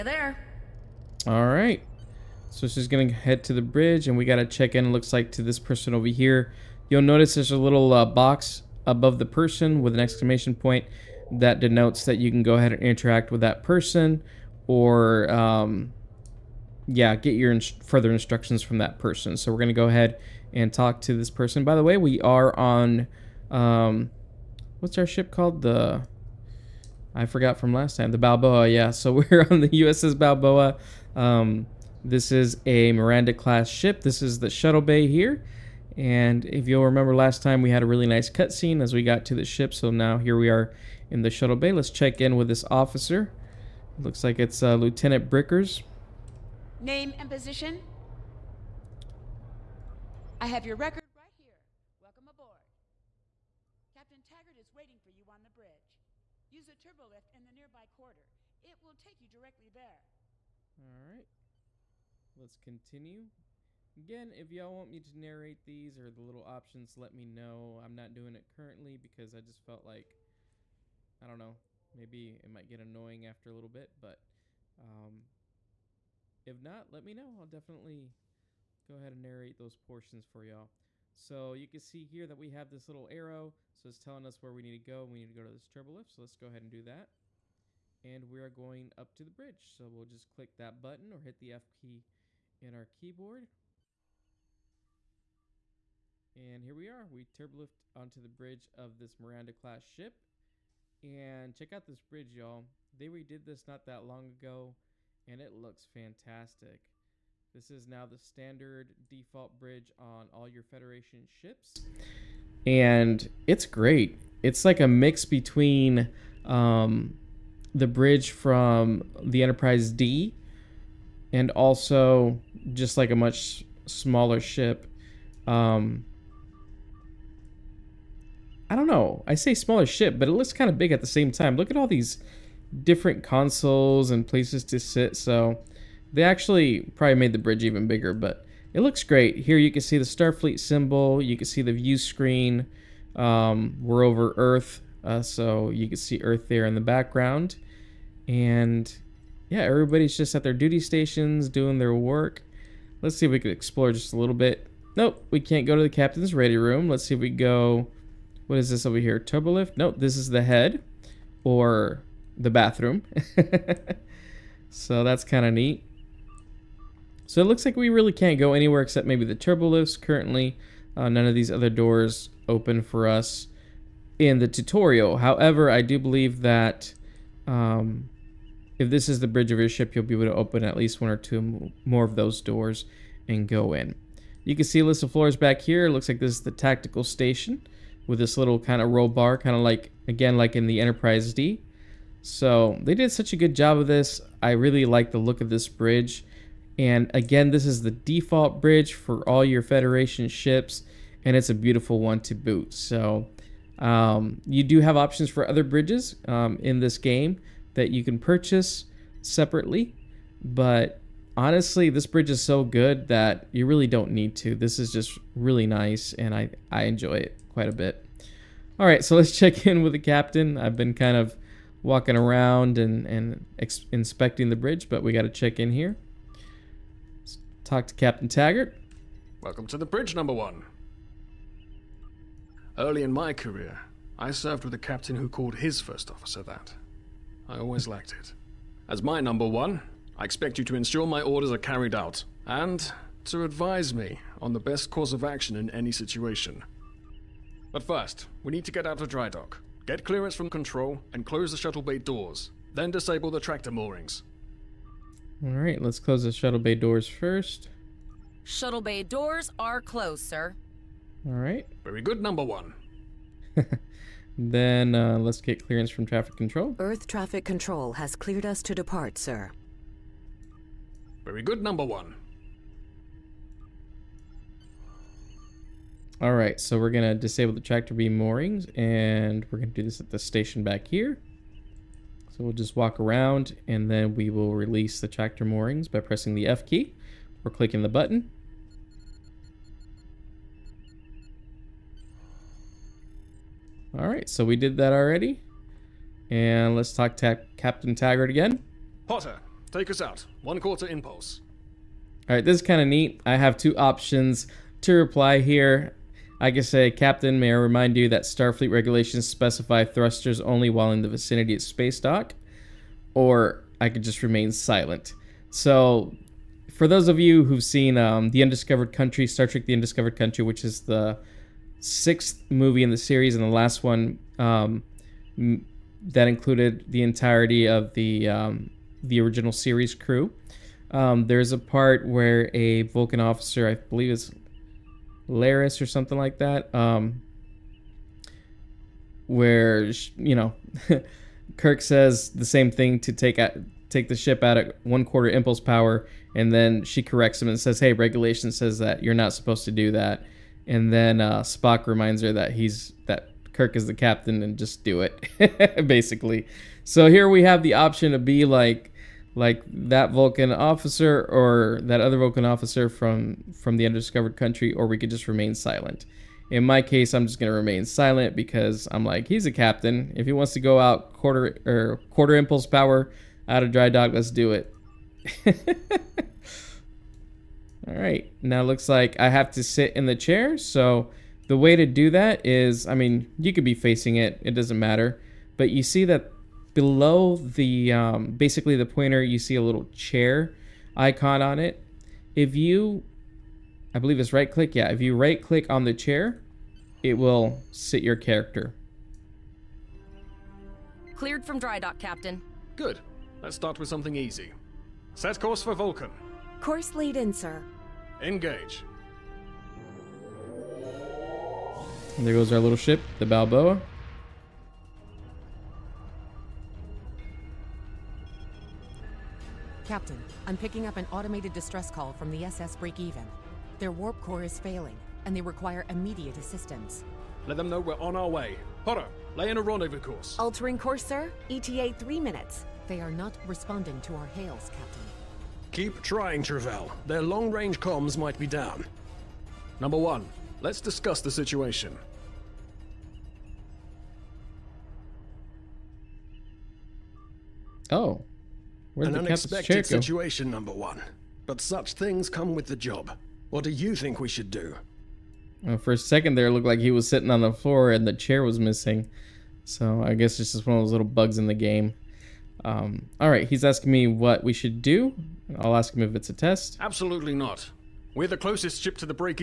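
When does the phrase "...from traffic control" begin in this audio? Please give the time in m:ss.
4:25.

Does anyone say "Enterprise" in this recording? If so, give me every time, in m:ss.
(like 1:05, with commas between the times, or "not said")
1:59, 3:10.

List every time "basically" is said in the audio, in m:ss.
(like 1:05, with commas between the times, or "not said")
5:55, 6:28.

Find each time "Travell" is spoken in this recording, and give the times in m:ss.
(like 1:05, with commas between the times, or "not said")
7:16.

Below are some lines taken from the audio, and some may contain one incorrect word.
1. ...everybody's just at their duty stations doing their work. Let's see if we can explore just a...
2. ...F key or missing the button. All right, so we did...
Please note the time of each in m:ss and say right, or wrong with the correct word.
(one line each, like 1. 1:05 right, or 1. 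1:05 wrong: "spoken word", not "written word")
1. 2:29 right
2. 4:46 wrong: "clicking", not "missing".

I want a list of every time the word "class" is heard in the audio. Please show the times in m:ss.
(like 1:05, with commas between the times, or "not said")
0:33, 1:39.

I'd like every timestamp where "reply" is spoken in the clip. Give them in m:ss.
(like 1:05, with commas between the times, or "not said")
5:04.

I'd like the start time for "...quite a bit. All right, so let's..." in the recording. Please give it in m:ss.
3:37.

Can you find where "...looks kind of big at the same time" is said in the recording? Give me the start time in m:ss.
2:10.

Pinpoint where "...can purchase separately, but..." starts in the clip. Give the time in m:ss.
3:28.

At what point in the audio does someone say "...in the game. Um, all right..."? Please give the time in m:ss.
7:41.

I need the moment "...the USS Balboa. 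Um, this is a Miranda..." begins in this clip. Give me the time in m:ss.
0:29.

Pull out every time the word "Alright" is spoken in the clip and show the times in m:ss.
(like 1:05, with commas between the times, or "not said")
4:15, 4:21.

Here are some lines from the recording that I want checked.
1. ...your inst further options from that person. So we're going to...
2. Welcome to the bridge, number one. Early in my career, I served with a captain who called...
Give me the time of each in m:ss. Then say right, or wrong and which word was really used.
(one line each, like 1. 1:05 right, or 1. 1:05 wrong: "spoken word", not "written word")
1. 0:17 wrong: "instructions", not "options"
2. 3:49 right.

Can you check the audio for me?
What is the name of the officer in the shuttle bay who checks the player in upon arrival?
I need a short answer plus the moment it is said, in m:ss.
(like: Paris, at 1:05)
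Lieutenant Brickers, at 0:44.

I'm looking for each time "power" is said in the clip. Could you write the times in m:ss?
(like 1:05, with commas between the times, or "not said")
5:45, 6:12.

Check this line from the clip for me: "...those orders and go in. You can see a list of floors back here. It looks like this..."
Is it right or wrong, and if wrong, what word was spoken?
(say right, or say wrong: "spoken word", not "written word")
wrong: "doors", not "orders".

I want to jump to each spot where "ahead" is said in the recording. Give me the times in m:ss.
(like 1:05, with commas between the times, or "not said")
0:12, 0:19, 1:18, 1:26.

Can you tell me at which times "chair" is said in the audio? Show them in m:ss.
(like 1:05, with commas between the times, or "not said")
6:20, 6:29, 6:35, 7:38.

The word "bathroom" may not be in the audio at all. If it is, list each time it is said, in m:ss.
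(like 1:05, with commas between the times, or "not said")
2:42.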